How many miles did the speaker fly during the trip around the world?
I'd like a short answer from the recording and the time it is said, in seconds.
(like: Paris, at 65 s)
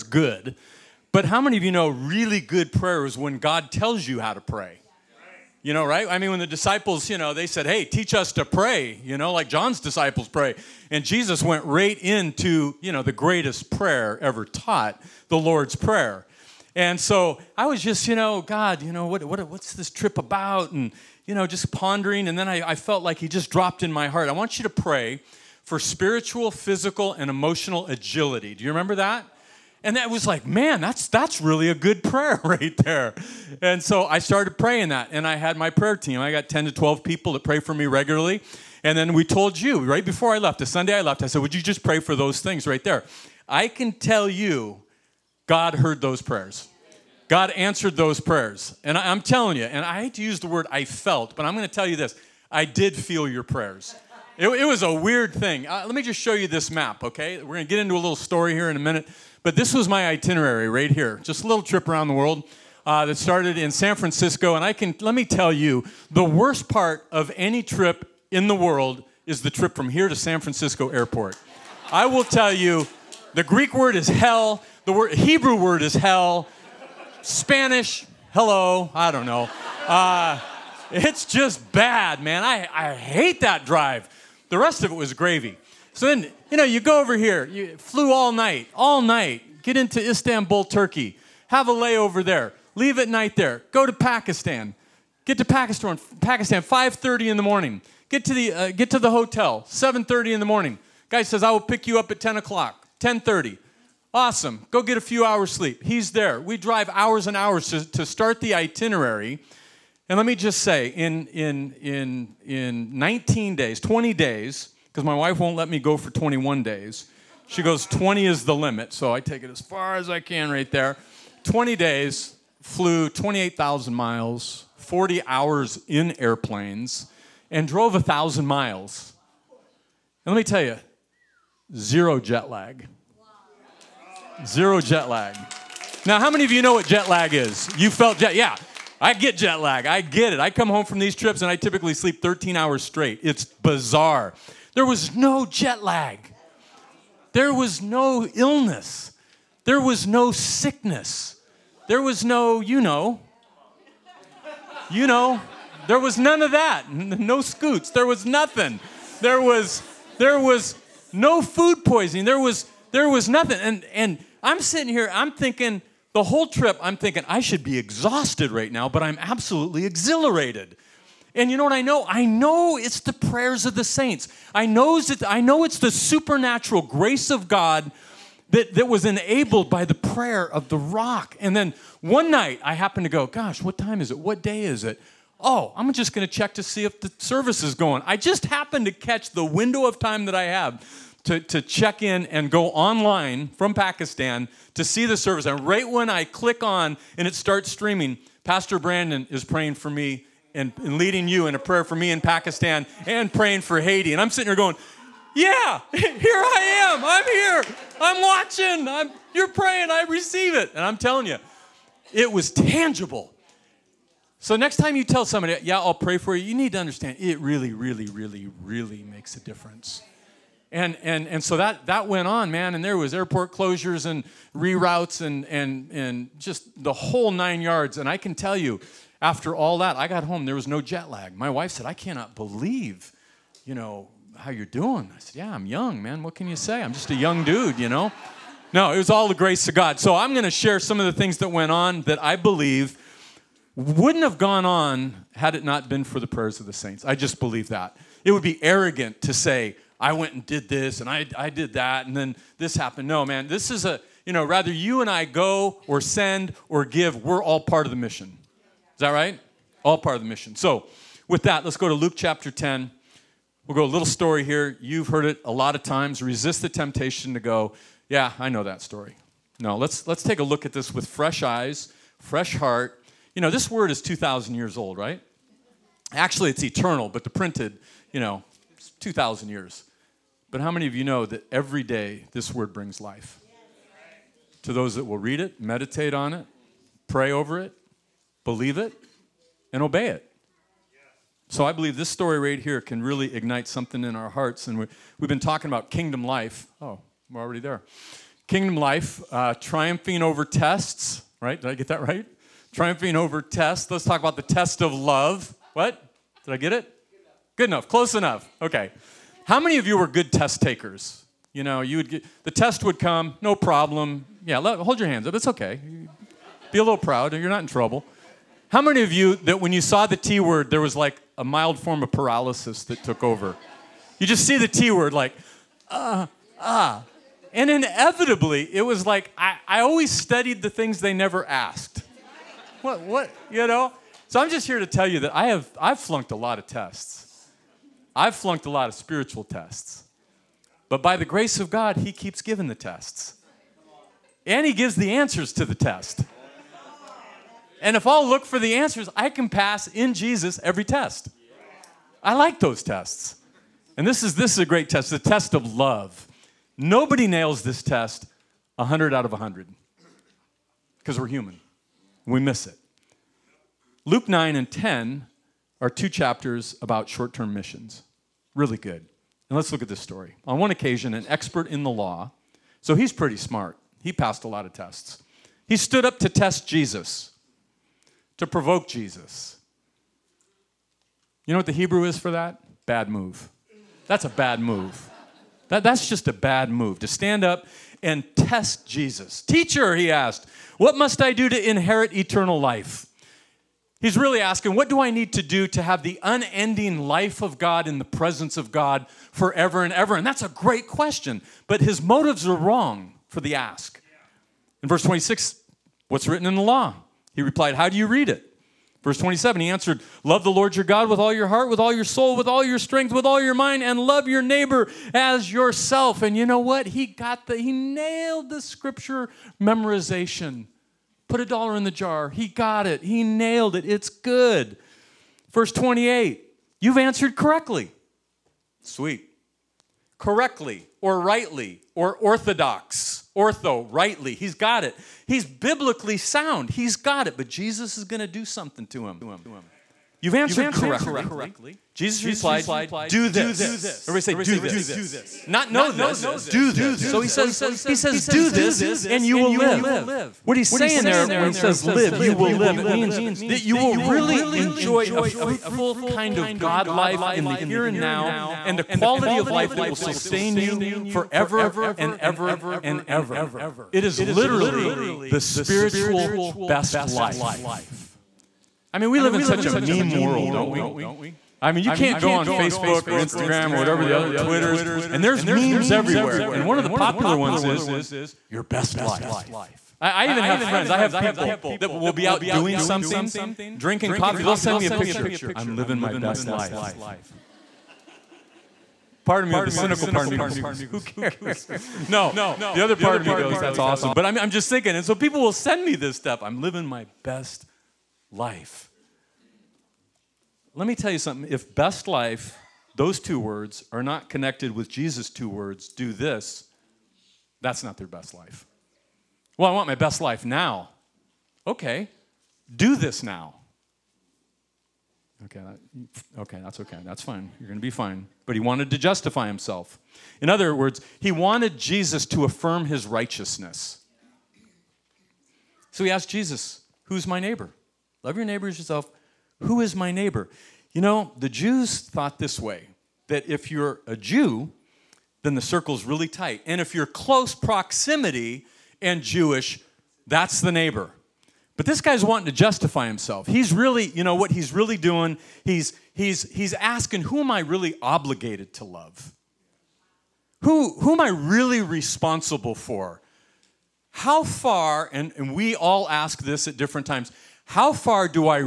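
28,000, at 123 s.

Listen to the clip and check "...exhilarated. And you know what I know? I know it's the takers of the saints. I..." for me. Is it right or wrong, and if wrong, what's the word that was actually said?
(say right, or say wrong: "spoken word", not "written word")
wrong: "prayers", not "takers".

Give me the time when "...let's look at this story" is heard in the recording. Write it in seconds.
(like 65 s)
369 s.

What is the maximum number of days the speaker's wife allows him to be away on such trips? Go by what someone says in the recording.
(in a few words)
20.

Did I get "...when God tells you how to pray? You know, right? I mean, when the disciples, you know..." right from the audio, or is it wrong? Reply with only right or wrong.
right.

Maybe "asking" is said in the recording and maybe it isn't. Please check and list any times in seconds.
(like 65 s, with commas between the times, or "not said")
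394 s, 546 s.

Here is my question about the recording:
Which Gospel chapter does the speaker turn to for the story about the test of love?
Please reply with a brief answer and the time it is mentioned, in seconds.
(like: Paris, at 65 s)
Luke 10, at 261 s.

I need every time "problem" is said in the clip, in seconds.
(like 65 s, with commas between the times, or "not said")
313 s.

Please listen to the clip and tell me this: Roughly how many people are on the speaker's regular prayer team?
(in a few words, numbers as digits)
10 to 12.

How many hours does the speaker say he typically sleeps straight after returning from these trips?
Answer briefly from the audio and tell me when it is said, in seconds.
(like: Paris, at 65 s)
13, at 142 s.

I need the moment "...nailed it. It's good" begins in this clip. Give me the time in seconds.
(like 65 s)
423 s.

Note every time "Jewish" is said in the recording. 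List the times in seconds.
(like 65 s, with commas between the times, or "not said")
539 s.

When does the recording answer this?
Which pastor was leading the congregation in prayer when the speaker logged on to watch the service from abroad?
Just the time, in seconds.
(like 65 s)
198 s.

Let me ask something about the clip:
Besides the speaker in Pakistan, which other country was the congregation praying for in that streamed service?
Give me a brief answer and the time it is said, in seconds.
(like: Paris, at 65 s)
Haiti, at 203 s.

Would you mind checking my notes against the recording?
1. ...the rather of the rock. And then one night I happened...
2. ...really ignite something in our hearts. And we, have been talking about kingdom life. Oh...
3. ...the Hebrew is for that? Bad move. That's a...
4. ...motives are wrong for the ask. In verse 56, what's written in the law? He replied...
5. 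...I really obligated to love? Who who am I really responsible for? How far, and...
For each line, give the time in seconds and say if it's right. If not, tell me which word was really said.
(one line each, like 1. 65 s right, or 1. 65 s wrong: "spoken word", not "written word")
1. 179 s wrong: "prayer", not "rather"
2. 293 s right
3. 381 s right
4. 401 s wrong: "26", not "56"
5. 547 s right.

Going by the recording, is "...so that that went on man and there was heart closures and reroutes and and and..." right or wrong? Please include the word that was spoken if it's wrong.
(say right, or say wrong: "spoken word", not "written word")
wrong: "airport", not "heart".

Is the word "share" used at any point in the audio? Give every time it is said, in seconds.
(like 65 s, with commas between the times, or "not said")
240 s.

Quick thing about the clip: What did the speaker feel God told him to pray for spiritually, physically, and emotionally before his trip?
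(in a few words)
Agility.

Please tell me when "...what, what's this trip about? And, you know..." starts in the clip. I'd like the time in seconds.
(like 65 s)
19 s.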